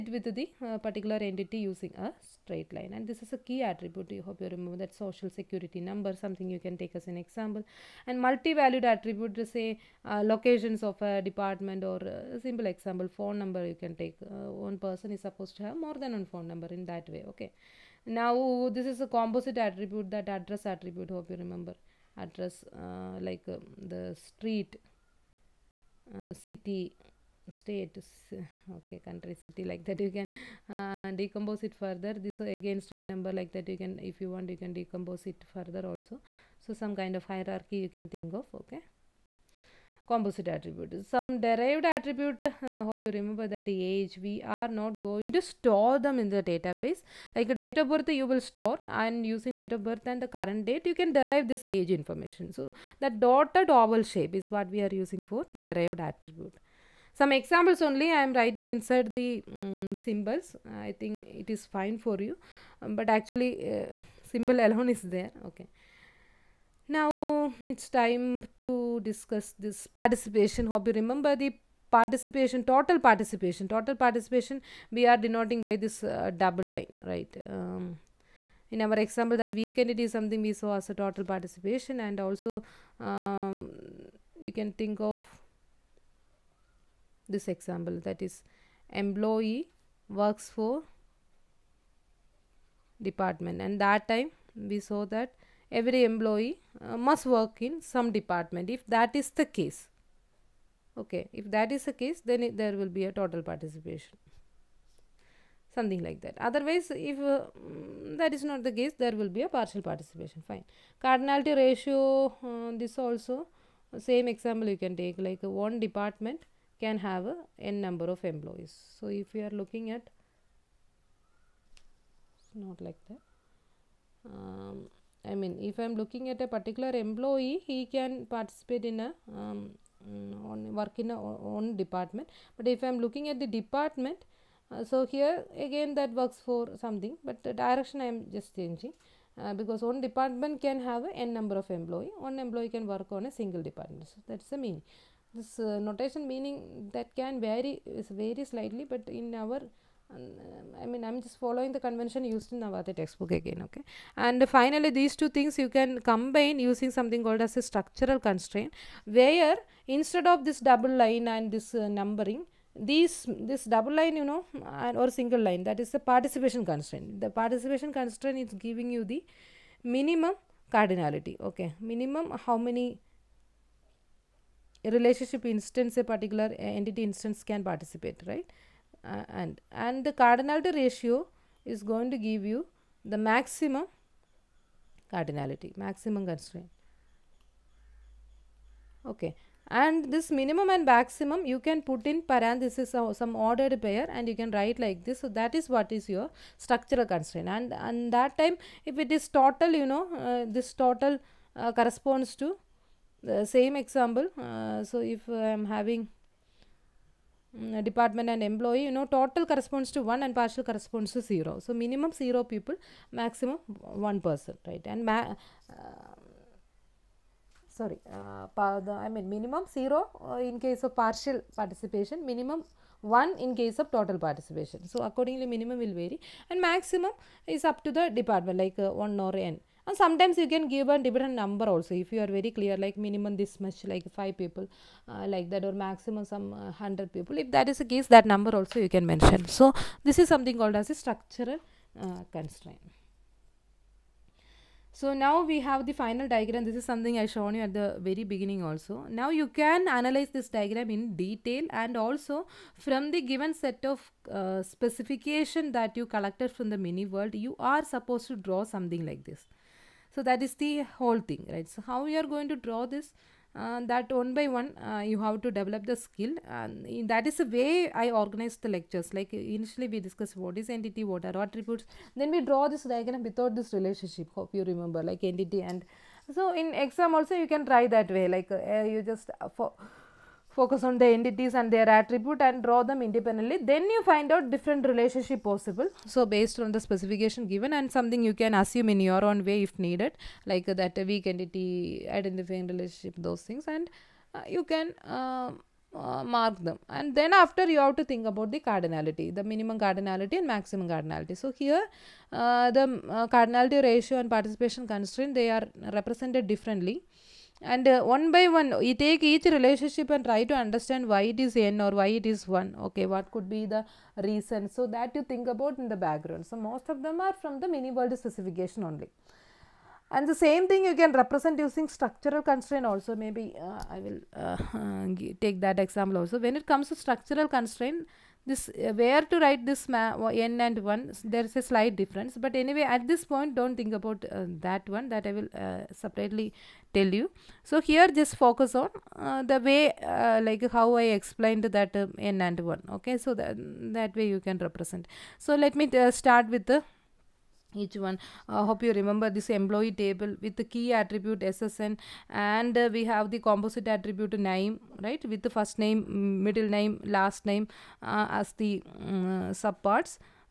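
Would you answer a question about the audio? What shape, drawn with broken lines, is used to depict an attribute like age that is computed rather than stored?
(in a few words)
dotted oval.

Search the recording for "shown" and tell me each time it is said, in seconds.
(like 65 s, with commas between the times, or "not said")
247 s.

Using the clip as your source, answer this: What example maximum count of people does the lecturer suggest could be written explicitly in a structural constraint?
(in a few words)
100.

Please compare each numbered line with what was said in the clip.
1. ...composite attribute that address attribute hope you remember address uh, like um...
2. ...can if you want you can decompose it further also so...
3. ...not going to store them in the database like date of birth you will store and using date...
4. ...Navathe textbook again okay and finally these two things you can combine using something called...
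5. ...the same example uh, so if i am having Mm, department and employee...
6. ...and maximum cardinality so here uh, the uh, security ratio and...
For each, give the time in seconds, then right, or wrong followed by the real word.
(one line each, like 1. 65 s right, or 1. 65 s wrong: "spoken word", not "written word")
1. 19 s right
2. 33 s right
3. 44 s right
4. 152 s right
5. 203 s right
6. 300 s wrong: "cardinality", not "security".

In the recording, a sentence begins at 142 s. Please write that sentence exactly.
One employee can work on a single department.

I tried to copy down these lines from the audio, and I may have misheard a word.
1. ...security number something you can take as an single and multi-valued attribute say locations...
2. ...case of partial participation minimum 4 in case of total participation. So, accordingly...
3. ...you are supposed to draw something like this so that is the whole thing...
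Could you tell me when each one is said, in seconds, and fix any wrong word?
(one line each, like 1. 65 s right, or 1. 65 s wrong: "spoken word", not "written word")
1. 5 s wrong: "example", not "single"
2. 220 s wrong: "1", not "4"
3. 257 s right.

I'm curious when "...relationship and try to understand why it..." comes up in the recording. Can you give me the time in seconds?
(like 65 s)
309 s.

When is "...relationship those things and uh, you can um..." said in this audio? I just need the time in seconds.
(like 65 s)
292 s.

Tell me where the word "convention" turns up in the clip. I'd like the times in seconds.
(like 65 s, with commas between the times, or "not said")
151 s.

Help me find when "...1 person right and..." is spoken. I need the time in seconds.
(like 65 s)
213 s.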